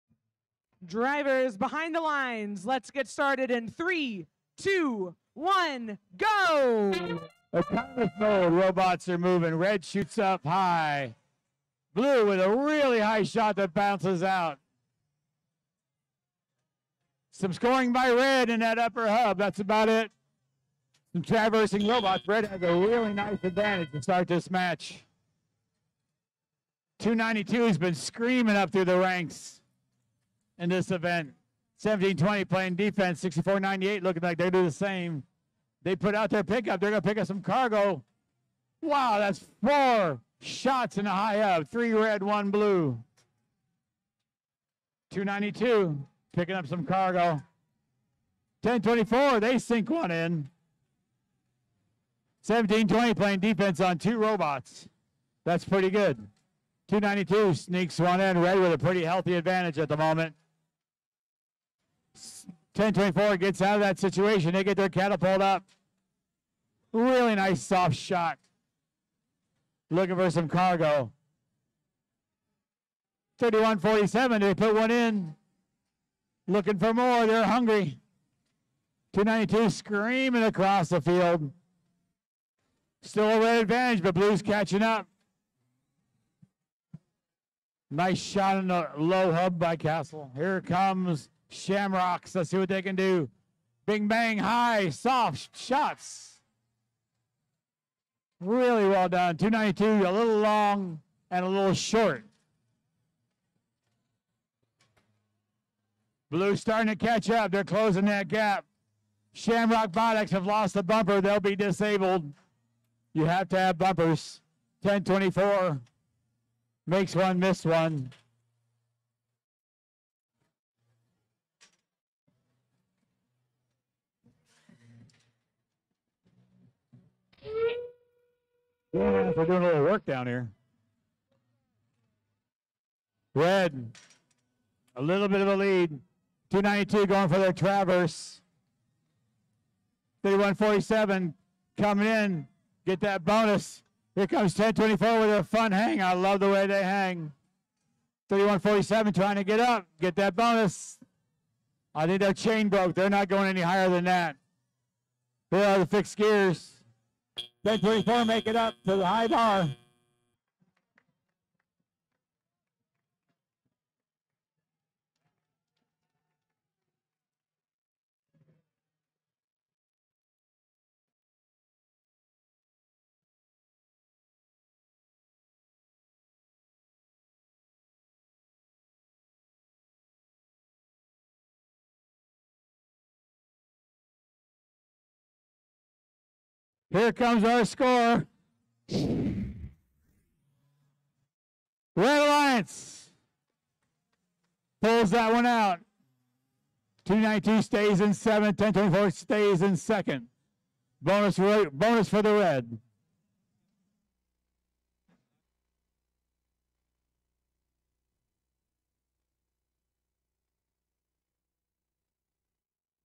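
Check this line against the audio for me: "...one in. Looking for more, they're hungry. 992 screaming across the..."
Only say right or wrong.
wrong.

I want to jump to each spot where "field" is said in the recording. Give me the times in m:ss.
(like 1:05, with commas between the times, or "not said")
1:21.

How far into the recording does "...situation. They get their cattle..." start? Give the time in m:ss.
1:03.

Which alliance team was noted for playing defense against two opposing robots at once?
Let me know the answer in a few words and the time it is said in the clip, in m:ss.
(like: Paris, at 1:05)
1720, at 0:52.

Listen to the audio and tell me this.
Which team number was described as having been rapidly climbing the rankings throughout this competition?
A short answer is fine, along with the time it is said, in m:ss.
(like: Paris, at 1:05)
292, at 0:26.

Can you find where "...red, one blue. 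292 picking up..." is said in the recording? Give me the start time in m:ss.
0:41.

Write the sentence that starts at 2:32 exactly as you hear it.
They're not going any higher than that.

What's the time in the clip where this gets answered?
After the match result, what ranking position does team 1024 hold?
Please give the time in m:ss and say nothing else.
3:19.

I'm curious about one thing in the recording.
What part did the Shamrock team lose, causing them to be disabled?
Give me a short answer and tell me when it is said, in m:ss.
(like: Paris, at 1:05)
Bumper, at 1:50.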